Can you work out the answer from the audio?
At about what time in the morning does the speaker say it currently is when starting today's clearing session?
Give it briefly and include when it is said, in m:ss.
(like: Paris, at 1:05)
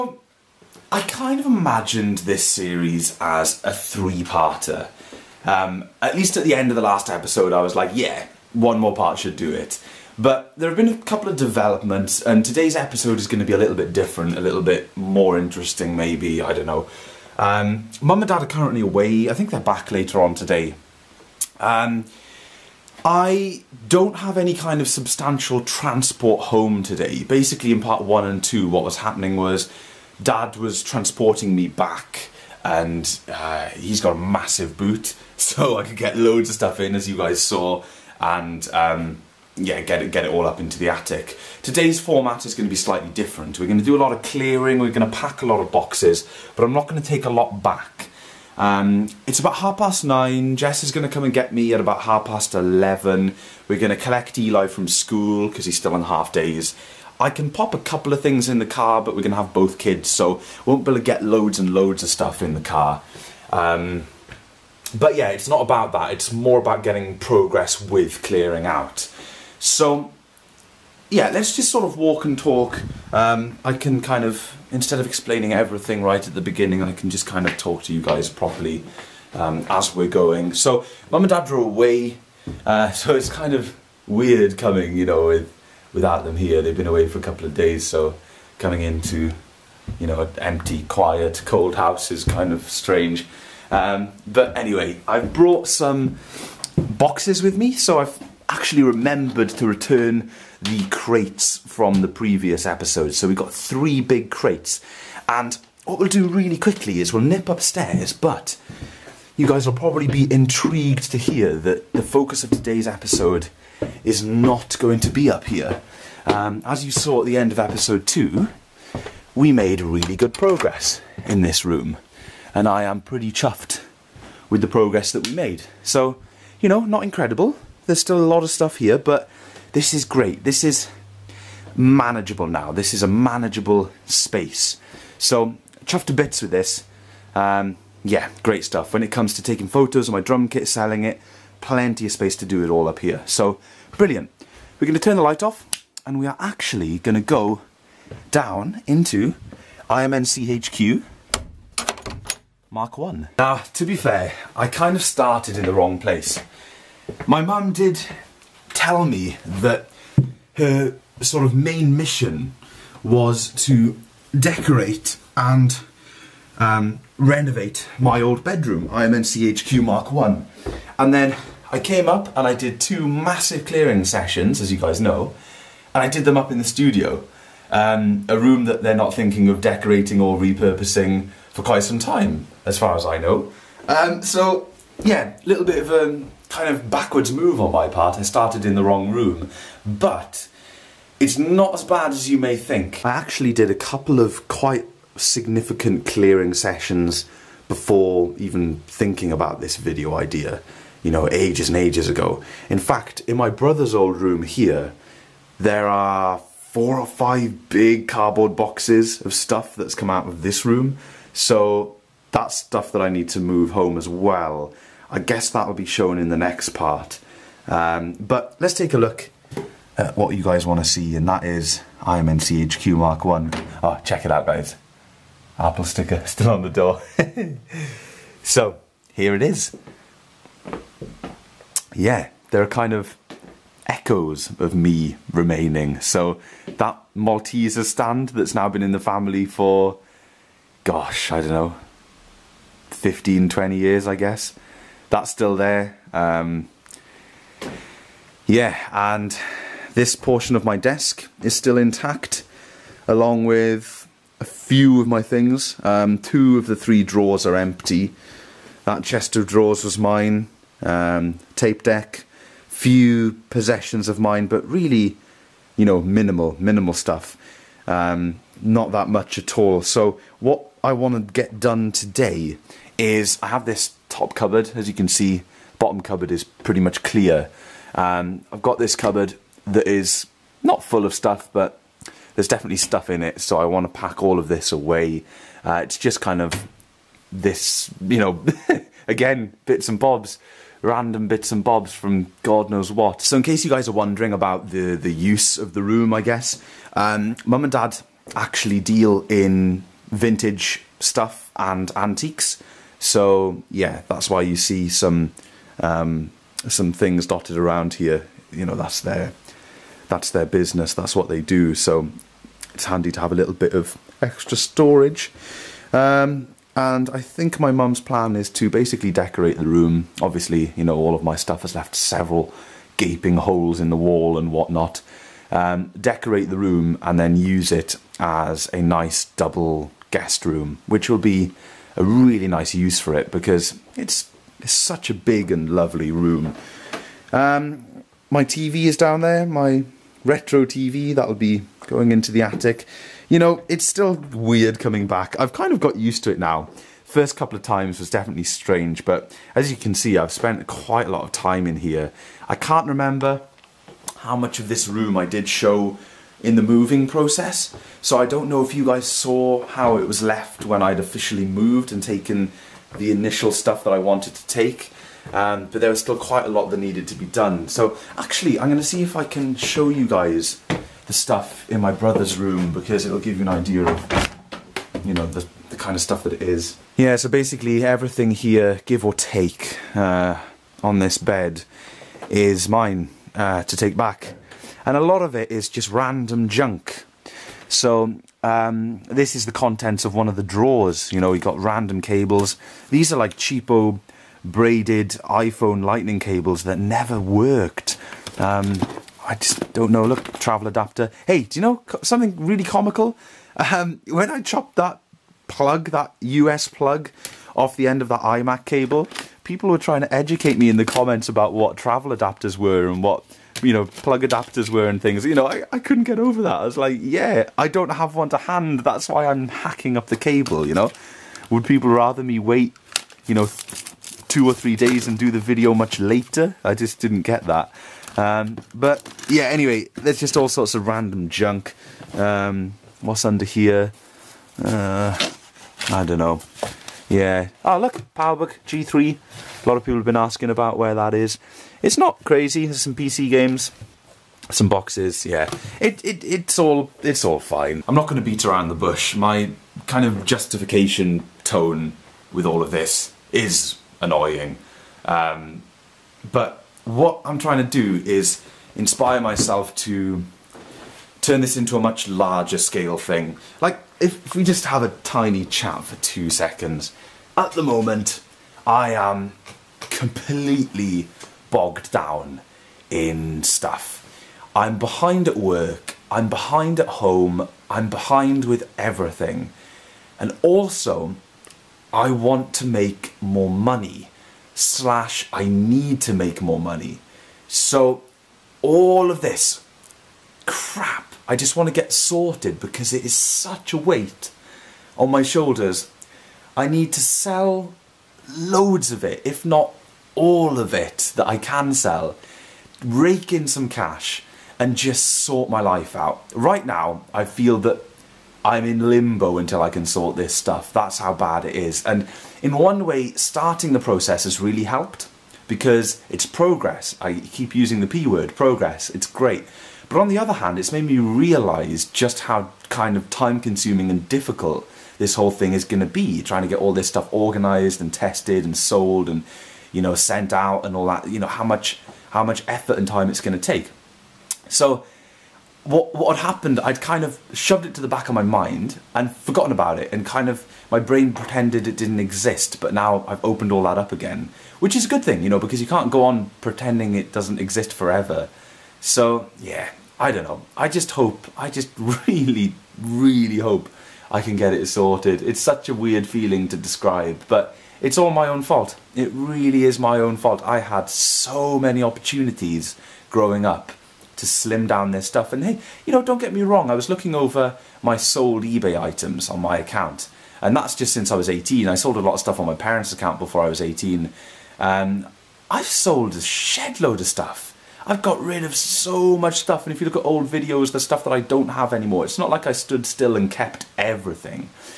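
half past nine, at 0:49.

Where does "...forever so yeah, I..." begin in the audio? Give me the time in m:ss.
9:07.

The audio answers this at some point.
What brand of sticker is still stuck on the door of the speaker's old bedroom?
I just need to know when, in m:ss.
3:45.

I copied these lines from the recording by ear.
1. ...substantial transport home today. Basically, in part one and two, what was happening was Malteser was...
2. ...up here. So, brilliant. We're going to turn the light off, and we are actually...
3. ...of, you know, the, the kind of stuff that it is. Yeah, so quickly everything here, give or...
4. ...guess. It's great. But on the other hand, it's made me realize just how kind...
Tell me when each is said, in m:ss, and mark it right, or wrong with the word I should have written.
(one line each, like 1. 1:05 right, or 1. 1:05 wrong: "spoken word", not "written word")
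1. 0:24 wrong: "Dad", not "Malteser"
2. 2:22 right
3. 6:13 wrong: "basically", not "quickly"
4. 8:38 wrong: "progress", not "guess".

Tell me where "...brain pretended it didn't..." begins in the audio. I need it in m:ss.
9:00.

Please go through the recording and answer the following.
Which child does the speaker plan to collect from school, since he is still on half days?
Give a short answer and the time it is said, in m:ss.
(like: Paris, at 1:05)
Eli, at 0:54.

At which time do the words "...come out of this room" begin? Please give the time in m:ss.
3:29.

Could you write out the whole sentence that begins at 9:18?
It really is my own fault.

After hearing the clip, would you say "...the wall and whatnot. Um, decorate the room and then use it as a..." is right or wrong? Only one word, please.
right.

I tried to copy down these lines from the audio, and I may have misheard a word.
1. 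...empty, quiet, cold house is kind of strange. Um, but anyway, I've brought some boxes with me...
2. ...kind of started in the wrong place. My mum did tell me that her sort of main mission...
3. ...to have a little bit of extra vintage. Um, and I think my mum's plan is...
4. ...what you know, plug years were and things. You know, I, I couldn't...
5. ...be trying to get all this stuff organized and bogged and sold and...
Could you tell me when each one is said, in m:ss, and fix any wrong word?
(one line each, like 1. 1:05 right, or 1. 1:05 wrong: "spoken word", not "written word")
1. 1:30 right
2. 2:34 right
3. 5:13 wrong: "storage", not "vintage"
4. 6:53 wrong: "adapters", not "years"
5. 8:45 wrong: "tested", not "bogged".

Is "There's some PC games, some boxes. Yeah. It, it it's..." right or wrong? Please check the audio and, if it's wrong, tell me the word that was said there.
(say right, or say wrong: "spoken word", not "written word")
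right.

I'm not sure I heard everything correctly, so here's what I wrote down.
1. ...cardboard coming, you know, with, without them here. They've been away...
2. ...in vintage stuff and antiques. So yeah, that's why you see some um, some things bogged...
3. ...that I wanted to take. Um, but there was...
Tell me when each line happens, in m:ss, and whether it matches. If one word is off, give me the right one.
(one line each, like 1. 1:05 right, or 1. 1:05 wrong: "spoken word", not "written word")
1. 1:24 wrong: "weird", not "cardboard"
2. 4:59 wrong: "dotted", not "bogged"
3. 6:03 right.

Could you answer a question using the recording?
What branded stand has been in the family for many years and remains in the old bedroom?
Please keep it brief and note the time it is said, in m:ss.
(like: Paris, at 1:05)
Malteser stand, at 3:57.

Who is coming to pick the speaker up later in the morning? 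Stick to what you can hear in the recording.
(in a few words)
Jess.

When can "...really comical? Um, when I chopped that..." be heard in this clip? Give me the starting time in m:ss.
6:42.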